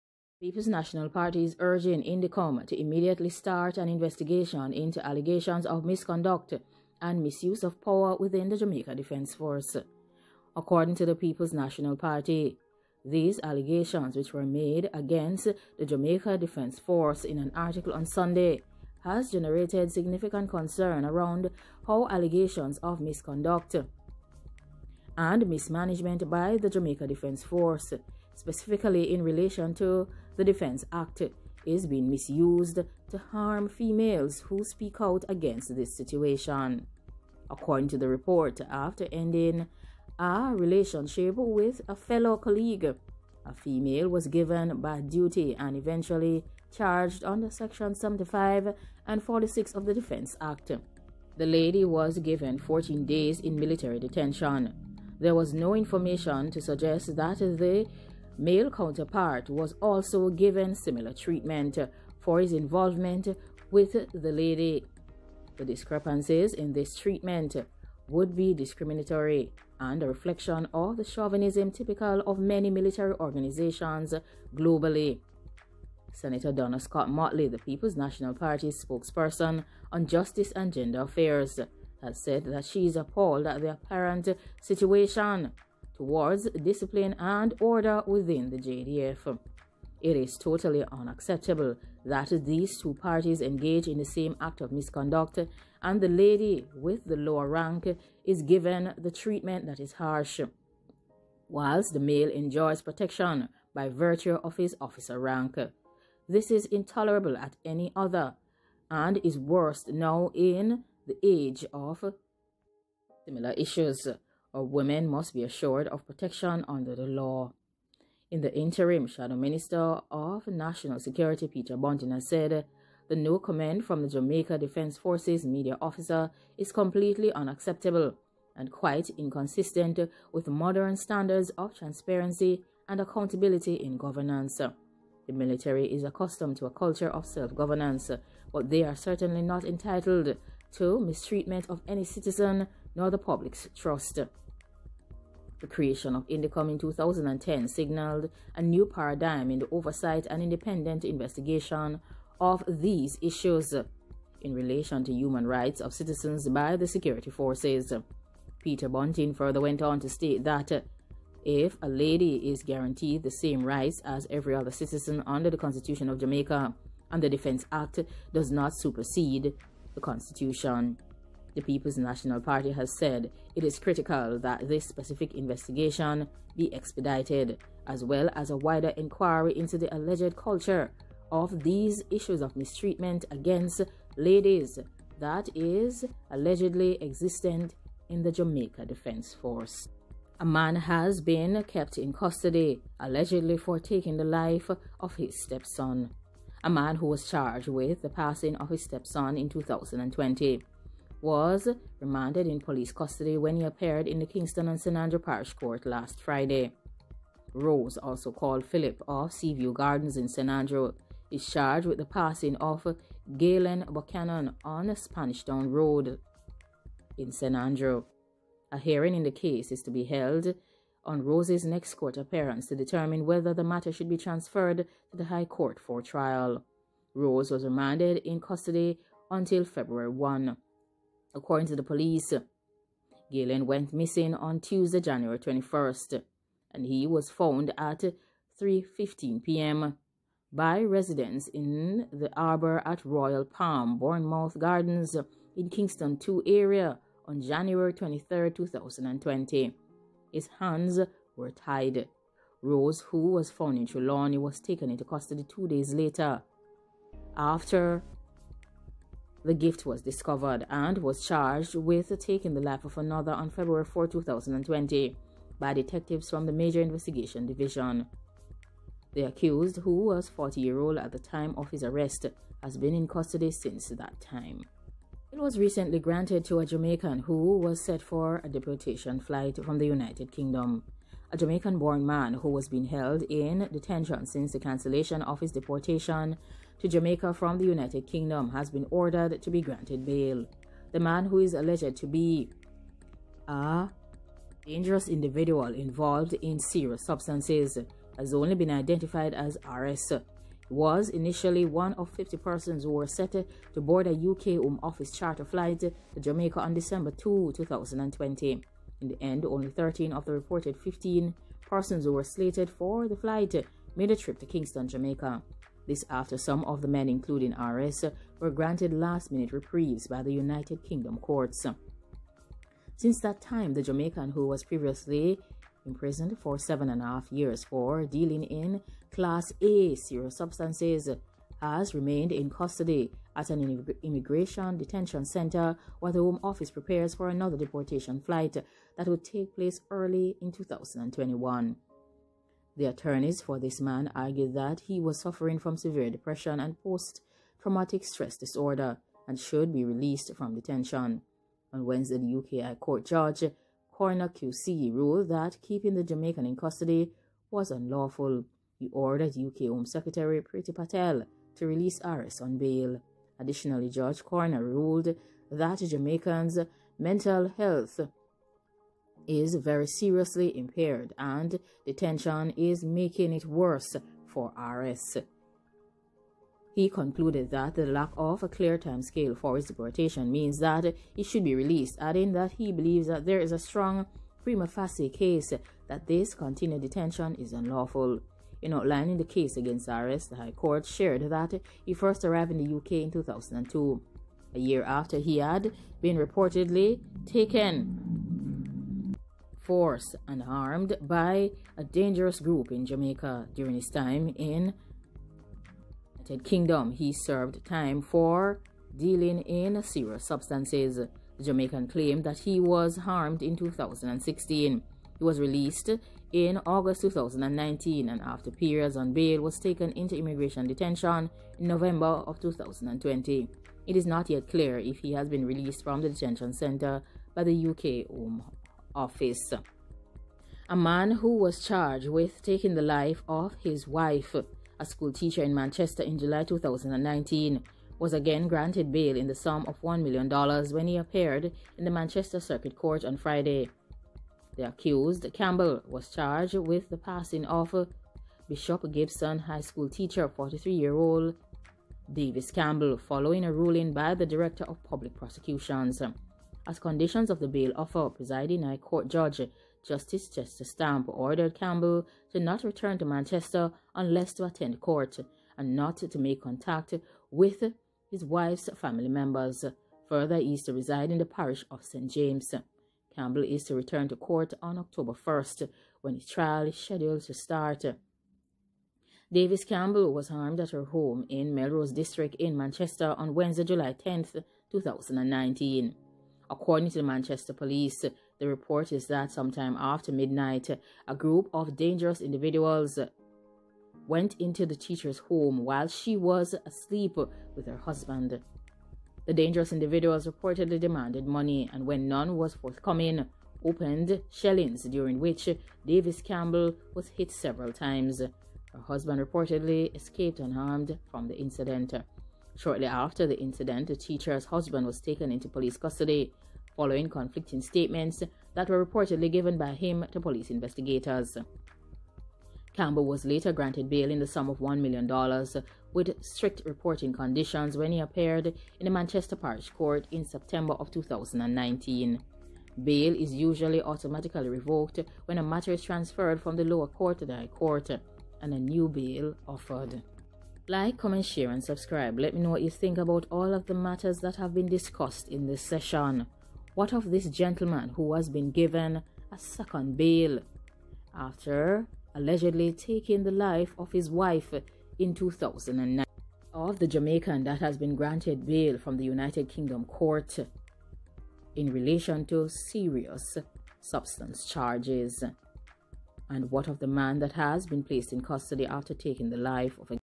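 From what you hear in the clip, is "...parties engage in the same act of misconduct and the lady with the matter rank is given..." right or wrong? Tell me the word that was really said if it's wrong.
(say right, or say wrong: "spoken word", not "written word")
wrong: "lower", not "matter".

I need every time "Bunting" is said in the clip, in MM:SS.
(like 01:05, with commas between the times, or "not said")
02:01, 02:38.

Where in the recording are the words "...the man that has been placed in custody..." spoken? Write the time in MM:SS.
09:26.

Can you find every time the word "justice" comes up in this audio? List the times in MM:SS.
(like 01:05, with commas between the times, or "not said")
01:20, 07:39.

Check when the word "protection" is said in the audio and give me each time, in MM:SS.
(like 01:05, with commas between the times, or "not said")
01:42, 01:56.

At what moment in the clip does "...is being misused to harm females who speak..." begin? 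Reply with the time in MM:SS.
00:31.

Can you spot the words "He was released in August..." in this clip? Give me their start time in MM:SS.
06:55.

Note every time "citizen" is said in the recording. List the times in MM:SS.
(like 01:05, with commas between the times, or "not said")
02:22, 02:35, 02:44.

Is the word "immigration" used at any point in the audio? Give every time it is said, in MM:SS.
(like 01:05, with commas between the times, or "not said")
05:34, 07:00.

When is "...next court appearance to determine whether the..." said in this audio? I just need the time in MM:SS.
03:41.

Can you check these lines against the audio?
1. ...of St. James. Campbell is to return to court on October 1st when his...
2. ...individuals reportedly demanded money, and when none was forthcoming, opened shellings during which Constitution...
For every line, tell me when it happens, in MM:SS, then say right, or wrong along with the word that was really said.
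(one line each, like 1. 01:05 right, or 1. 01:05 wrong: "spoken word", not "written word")
1. 07:51 right
2. 08:19 wrong: "Davis", not "Constitution".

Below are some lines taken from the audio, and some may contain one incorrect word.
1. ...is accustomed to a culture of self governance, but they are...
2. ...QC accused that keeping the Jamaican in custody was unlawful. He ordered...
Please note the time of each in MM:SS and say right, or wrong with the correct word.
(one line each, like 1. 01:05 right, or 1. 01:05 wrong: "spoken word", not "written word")
1. 02:15 right
2. 05:54 wrong: "ruled", not "accused".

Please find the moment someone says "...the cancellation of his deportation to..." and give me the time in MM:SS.
04:44.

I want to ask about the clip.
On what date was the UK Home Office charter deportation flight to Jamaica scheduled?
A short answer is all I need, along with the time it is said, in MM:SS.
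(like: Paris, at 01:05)
December 2, 2020, at 05:06.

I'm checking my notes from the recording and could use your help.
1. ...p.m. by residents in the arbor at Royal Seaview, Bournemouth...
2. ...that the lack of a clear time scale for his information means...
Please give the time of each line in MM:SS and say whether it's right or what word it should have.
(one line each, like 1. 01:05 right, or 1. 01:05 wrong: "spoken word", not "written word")
1. 03:59 wrong: "Palm", not "Seaview"
2. 06:17 wrong: "deportation", not "information".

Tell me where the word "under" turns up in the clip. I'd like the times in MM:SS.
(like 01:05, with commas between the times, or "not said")
00:47, 01:56, 02:45.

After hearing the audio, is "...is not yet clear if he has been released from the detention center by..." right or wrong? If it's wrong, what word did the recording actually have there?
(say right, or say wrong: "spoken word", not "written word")
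right.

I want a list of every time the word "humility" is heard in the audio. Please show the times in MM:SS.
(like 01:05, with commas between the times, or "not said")
not said.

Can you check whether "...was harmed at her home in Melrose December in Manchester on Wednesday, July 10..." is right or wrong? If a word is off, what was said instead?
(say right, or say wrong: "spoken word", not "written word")
wrong: "District", not "December".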